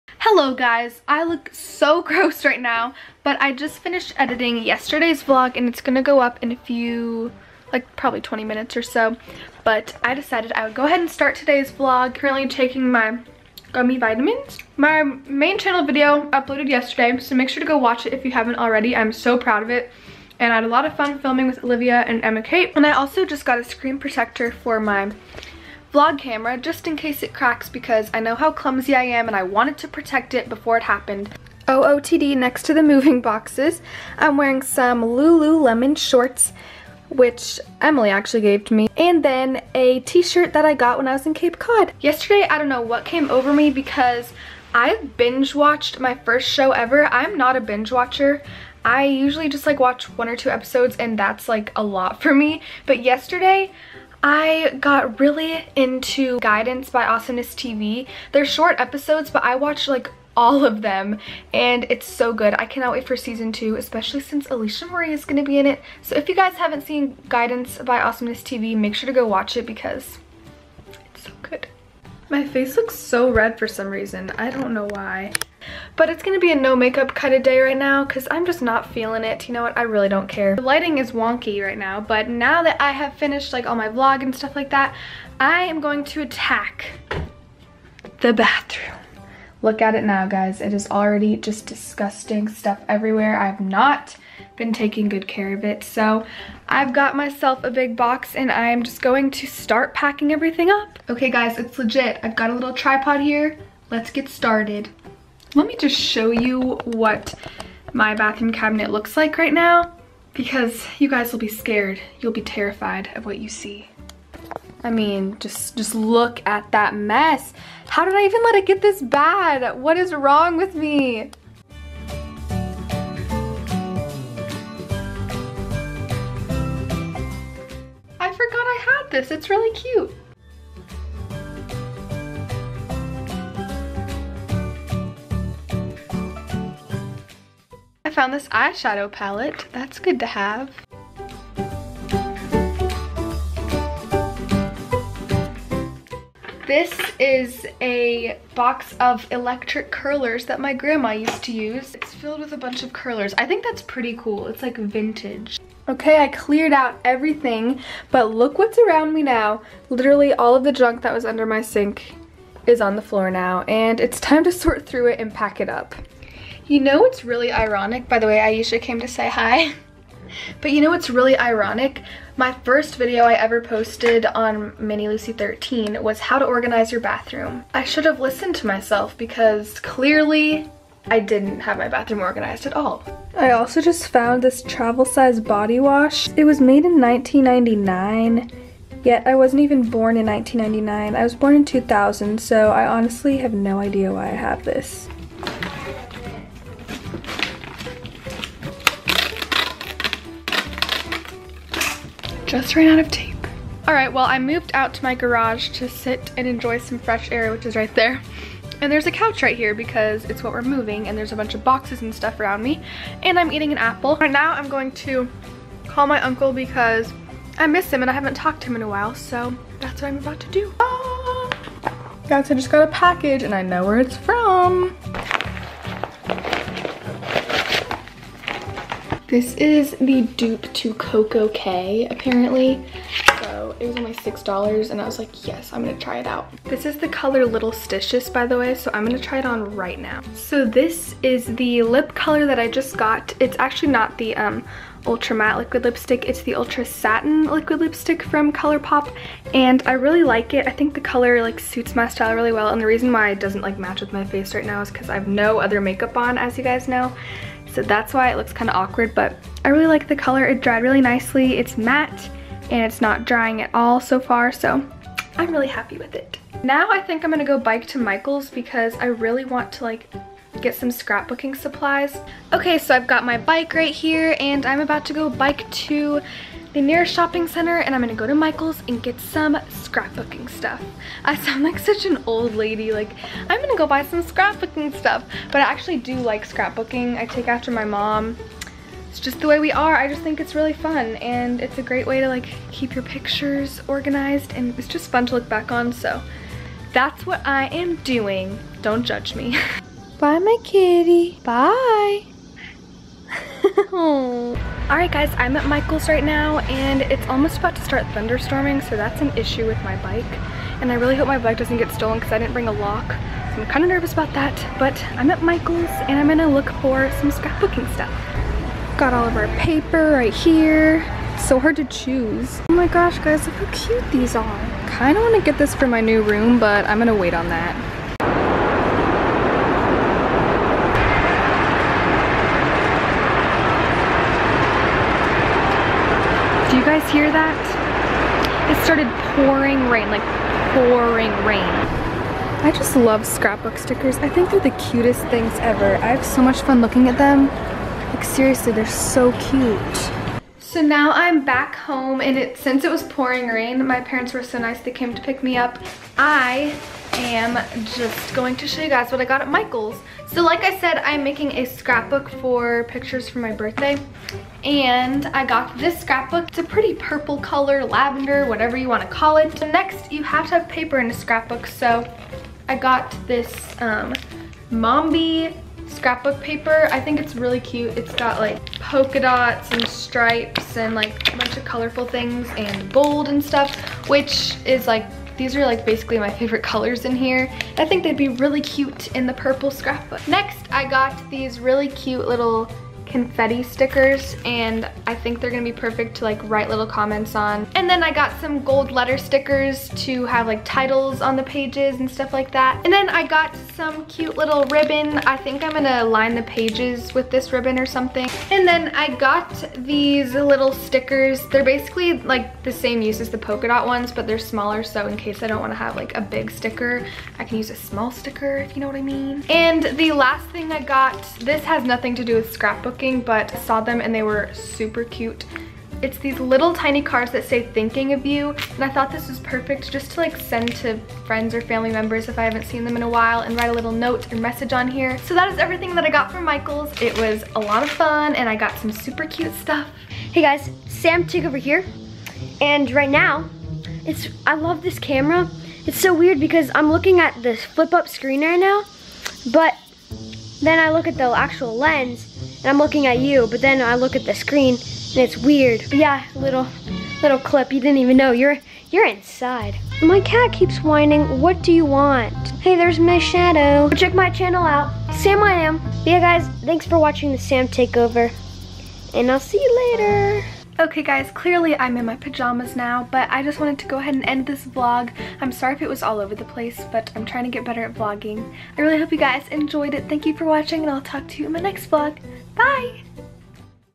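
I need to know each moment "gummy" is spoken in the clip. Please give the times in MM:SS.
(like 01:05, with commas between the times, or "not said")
00:13.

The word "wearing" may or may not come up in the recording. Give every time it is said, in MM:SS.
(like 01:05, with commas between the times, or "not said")
00:34.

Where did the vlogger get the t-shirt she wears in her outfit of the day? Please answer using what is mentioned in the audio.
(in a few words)
Cape Cod.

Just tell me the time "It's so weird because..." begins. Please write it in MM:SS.
07:25.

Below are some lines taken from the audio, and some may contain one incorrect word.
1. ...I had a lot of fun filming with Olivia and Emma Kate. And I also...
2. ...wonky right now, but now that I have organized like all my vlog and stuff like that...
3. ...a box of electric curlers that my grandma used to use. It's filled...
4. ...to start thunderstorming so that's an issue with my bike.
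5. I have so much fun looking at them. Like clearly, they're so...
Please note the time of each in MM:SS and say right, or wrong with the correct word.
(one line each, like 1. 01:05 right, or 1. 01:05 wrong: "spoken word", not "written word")
1. 00:20 right
2. 01:21 wrong: "finished", not "organized"
3. 02:27 right
4. 05:07 right
5. 05:45 wrong: "seriously", not "clearly".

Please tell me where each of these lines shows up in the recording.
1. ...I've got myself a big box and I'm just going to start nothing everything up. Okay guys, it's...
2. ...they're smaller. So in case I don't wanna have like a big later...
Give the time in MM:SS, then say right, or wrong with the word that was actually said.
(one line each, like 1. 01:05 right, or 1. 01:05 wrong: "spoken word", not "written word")
1. 01:36 wrong: "packing", not "nothing"
2. 06:54 wrong: "sticker", not "later".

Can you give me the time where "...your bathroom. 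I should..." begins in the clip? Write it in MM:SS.
02:56.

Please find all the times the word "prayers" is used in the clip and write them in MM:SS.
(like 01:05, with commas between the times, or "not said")
not said.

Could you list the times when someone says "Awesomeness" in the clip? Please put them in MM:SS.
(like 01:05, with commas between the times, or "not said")
00:57, 01:07.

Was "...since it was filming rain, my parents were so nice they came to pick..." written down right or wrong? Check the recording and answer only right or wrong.
wrong.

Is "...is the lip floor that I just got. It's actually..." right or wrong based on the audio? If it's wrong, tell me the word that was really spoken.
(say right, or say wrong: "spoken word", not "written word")
wrong: "color", not "floor".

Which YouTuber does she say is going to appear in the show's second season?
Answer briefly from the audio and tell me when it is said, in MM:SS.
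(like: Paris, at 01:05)
Alisha Marie, at 01:04.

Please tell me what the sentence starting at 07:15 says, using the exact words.
So that is everything that I got from Michaels.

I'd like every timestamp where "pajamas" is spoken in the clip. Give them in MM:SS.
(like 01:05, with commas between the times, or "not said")
07:52.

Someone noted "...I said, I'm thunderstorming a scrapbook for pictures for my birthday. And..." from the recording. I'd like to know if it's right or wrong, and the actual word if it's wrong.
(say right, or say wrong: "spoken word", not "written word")
wrong: "making", not "thunderstorming".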